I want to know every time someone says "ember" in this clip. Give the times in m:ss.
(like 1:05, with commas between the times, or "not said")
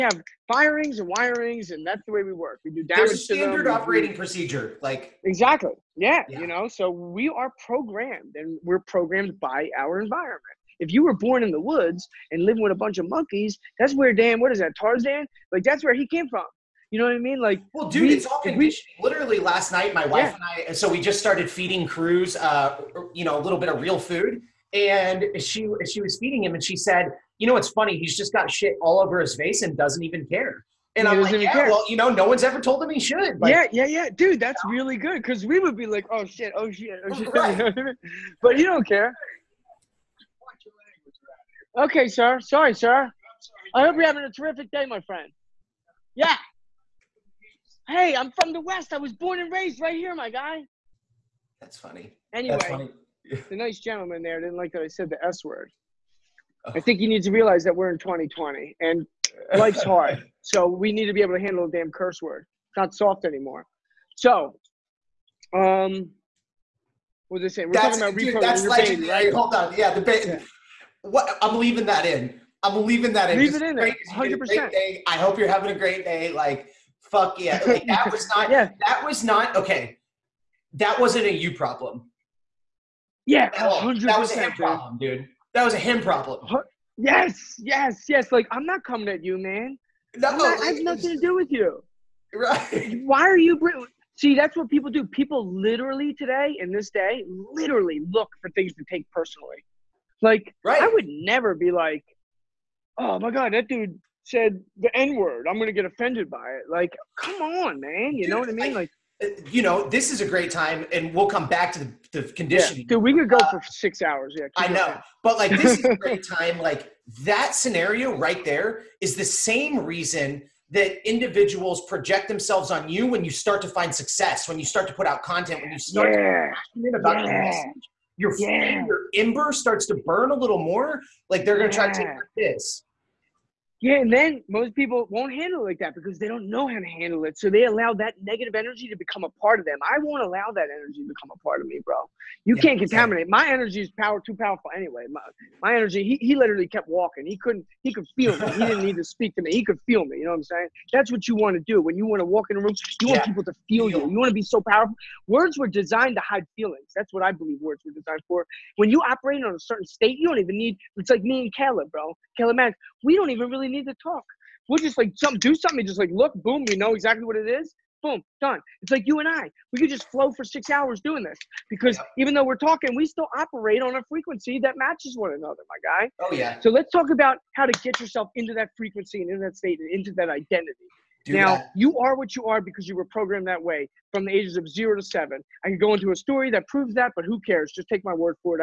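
2:09.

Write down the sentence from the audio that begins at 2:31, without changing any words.
When you want to walk in a room, you want people to feel you.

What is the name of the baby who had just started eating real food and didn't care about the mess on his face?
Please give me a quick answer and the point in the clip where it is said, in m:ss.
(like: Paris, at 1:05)
Cruz, at 0:21.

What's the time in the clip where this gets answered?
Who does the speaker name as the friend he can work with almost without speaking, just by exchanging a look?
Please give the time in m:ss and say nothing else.
2:42.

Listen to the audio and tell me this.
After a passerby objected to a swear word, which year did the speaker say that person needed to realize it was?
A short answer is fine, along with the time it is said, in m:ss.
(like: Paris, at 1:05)
2020, at 0:57.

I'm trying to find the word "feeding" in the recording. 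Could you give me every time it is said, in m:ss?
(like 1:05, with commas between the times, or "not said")
0:21, 0:26.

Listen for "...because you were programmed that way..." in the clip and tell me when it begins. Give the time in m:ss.
3:02.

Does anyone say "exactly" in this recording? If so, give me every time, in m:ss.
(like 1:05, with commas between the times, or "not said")
0:05, 2:23, 2:46.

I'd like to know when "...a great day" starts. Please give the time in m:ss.
1:15.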